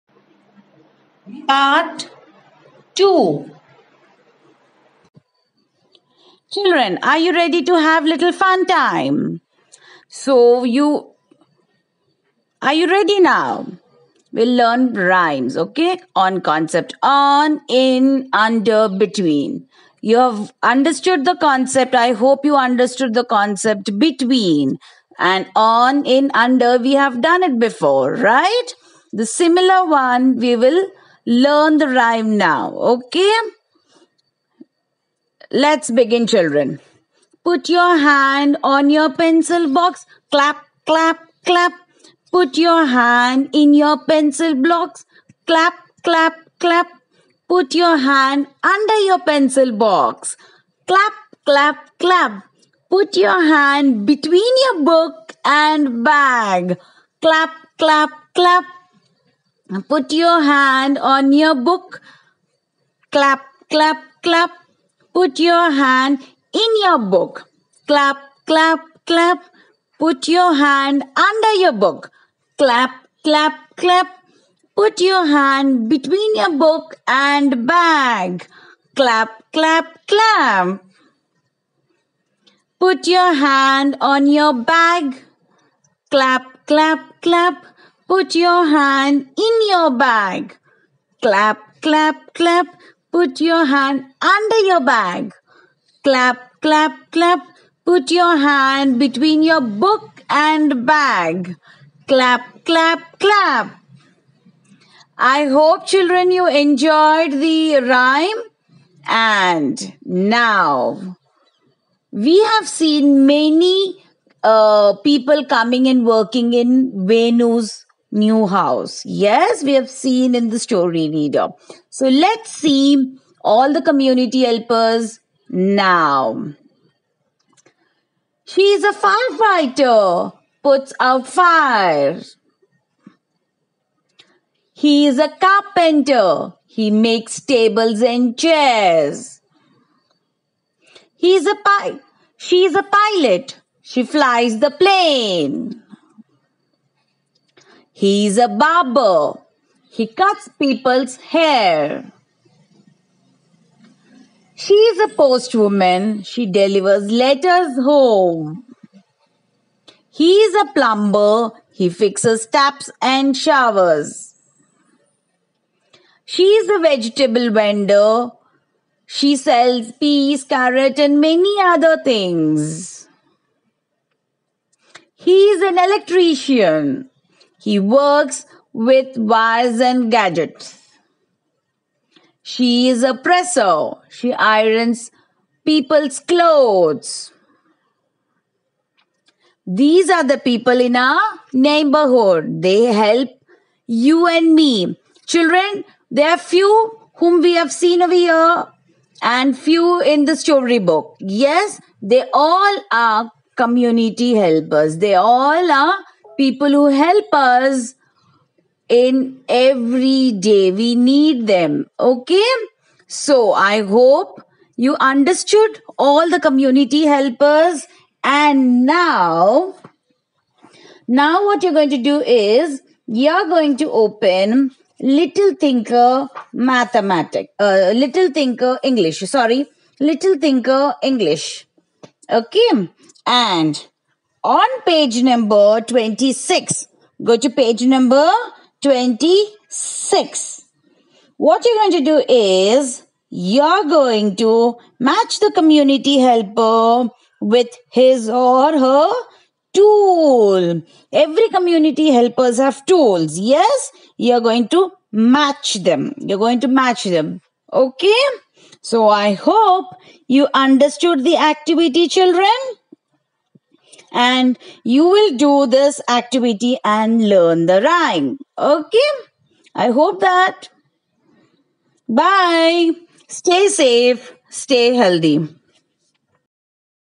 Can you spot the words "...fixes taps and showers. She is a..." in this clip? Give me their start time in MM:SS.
02:41.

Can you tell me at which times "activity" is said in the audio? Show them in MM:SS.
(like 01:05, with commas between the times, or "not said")
04:21, 04:26.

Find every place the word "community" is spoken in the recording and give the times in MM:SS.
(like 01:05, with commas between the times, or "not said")
02:03, 03:23, 03:36, 04:05, 04:11.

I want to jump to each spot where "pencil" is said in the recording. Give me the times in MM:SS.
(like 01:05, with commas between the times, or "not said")
00:39, 00:44, 00:49.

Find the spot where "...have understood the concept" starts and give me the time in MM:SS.
00:20.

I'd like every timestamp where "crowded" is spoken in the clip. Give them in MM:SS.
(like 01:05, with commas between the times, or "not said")
not said.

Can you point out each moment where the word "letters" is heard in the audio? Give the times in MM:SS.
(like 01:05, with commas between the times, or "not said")
02:37.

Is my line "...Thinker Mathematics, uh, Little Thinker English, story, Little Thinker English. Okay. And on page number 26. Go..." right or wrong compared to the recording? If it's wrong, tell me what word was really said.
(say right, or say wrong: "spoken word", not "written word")
wrong: "sorry", not "story".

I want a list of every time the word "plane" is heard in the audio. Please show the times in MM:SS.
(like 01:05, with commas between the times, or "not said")
02:24.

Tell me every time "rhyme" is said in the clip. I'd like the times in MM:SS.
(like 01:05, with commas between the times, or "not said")
00:14, 00:31, 01:47, 04:27.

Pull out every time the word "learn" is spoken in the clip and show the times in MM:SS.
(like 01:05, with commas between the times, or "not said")
00:14, 00:31, 04:27.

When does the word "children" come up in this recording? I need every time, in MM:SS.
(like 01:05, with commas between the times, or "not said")
00:06, 00:36, 01:45, 03:15, 04:22.